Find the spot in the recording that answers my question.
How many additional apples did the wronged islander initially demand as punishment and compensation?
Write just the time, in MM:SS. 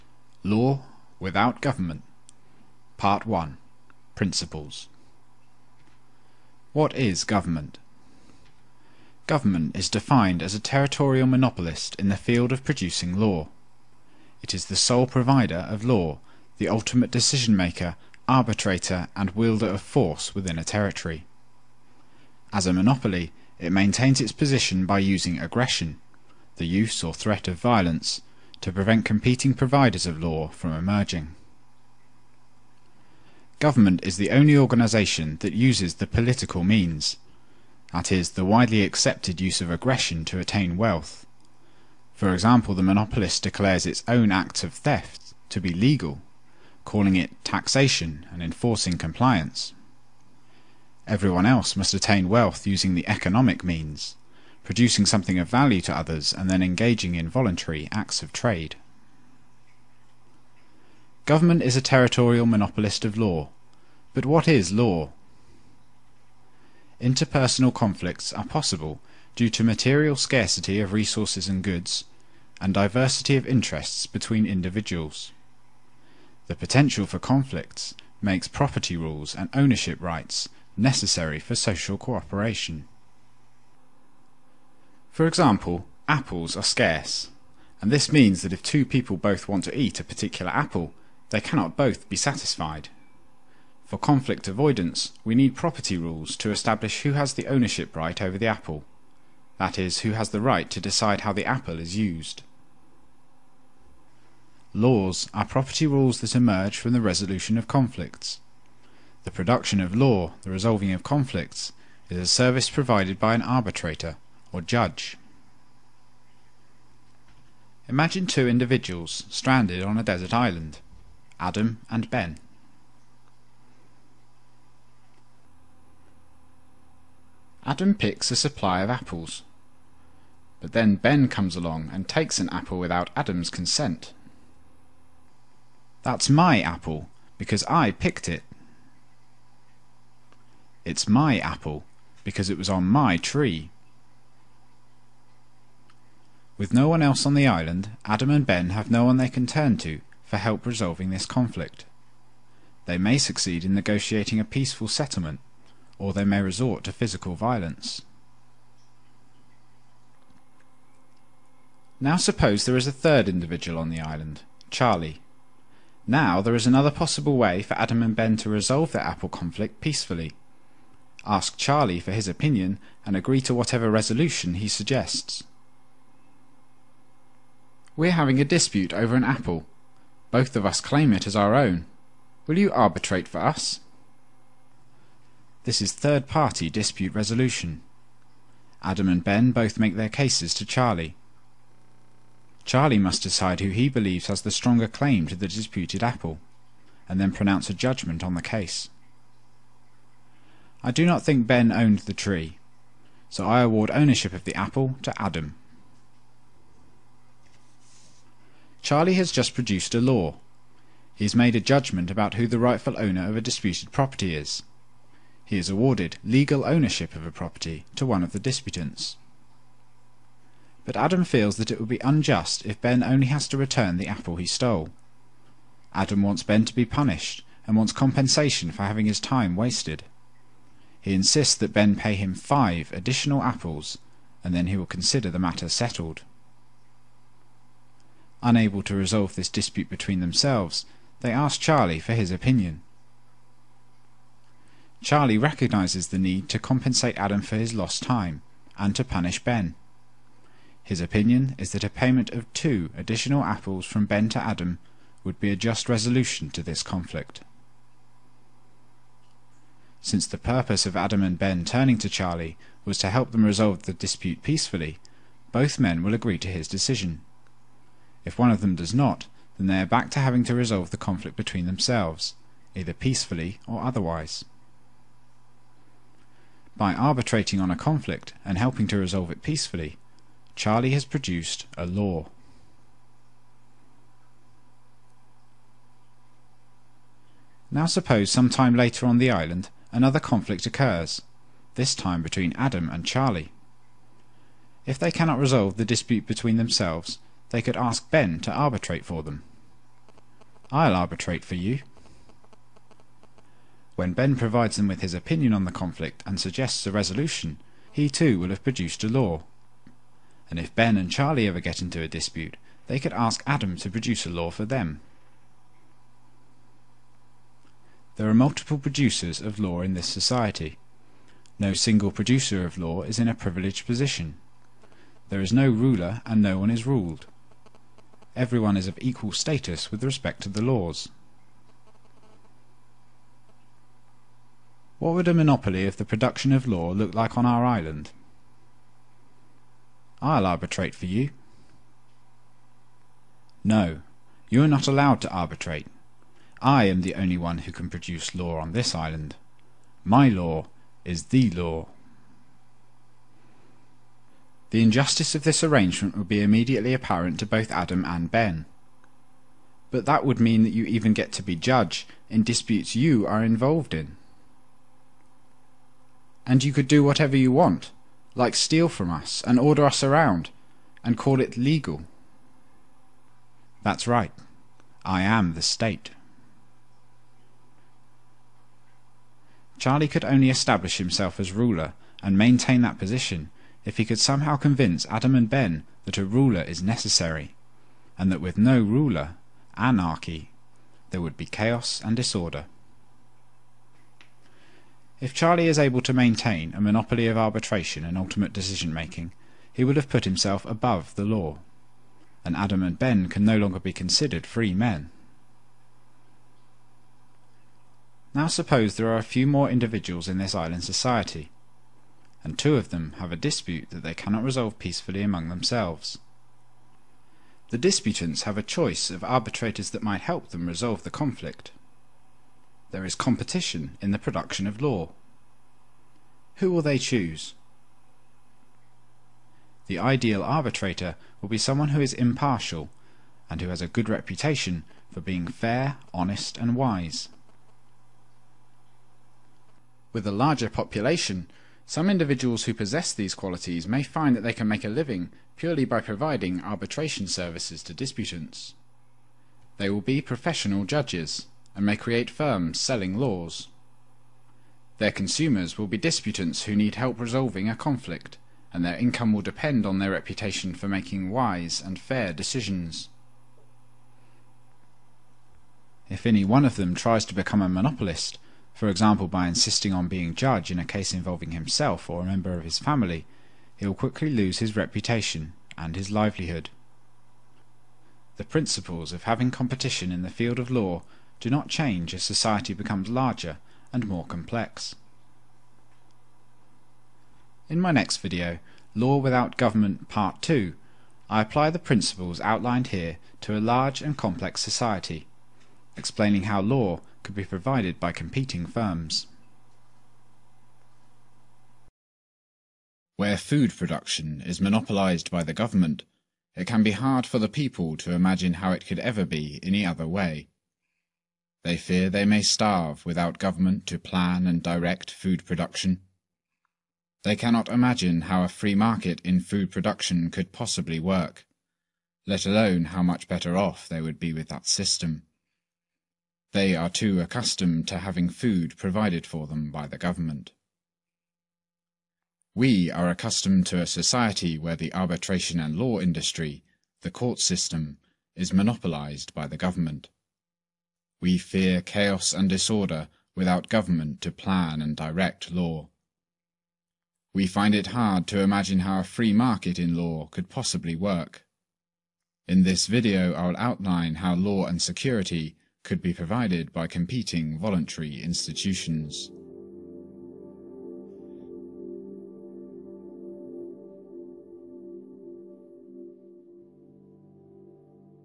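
03:52.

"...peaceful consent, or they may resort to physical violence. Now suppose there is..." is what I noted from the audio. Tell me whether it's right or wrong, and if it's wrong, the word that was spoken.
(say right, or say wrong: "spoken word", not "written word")
wrong: "settlement", not "consent".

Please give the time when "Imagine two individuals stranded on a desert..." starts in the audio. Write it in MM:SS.
01:57.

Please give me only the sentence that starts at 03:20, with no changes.
I do not think Ben owned the tree, so I award ownership of the apple to Adam.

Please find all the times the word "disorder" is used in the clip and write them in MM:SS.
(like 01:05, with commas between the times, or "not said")
06:32, 09:02.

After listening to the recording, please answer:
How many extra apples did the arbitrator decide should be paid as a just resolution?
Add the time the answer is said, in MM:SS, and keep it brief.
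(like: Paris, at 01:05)
2, at 04:12.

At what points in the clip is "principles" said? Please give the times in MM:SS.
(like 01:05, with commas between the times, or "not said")
00:04, 07:58, 08:11.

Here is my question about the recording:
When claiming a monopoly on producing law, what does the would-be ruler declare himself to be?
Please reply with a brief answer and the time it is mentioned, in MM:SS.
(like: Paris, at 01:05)
the state, at 06:15.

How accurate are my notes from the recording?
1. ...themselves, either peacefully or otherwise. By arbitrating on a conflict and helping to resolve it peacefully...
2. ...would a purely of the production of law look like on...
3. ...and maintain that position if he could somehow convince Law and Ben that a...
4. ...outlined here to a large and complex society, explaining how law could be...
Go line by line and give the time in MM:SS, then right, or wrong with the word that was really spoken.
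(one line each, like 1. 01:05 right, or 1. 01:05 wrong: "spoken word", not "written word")
1. 04:31 right
2. 05:35 wrong: "monopoly", not "purely"
3. 06:22 wrong: "Adam", not "Law"
4. 08:12 right.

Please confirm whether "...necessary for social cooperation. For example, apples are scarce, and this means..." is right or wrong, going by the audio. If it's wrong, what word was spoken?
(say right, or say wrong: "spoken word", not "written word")
right.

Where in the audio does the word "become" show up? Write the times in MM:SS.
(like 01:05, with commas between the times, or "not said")
07:47, 08:02.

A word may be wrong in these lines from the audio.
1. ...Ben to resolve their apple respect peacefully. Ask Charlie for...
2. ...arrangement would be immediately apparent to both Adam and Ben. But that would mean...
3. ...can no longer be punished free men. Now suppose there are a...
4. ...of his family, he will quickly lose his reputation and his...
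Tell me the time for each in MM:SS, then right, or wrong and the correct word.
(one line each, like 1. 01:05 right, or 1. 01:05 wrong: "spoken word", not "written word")
1. 02:48 wrong: "conflict", not "respect"
2. 05:55 right
3. 06:43 wrong: "considered", not "punished"
4. 07:52 right.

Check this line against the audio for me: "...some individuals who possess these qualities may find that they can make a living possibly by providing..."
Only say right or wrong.
wrong.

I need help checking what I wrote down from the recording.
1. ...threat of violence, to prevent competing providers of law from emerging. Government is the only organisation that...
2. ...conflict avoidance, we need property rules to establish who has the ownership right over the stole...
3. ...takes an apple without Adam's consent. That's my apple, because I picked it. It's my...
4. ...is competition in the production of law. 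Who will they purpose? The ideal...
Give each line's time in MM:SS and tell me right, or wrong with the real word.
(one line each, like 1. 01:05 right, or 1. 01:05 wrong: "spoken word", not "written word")
1. 00:27 right
2. 01:33 wrong: "apple", not "stole"
3. 02:12 right
4. 07:03 wrong: "choose", not "purpose".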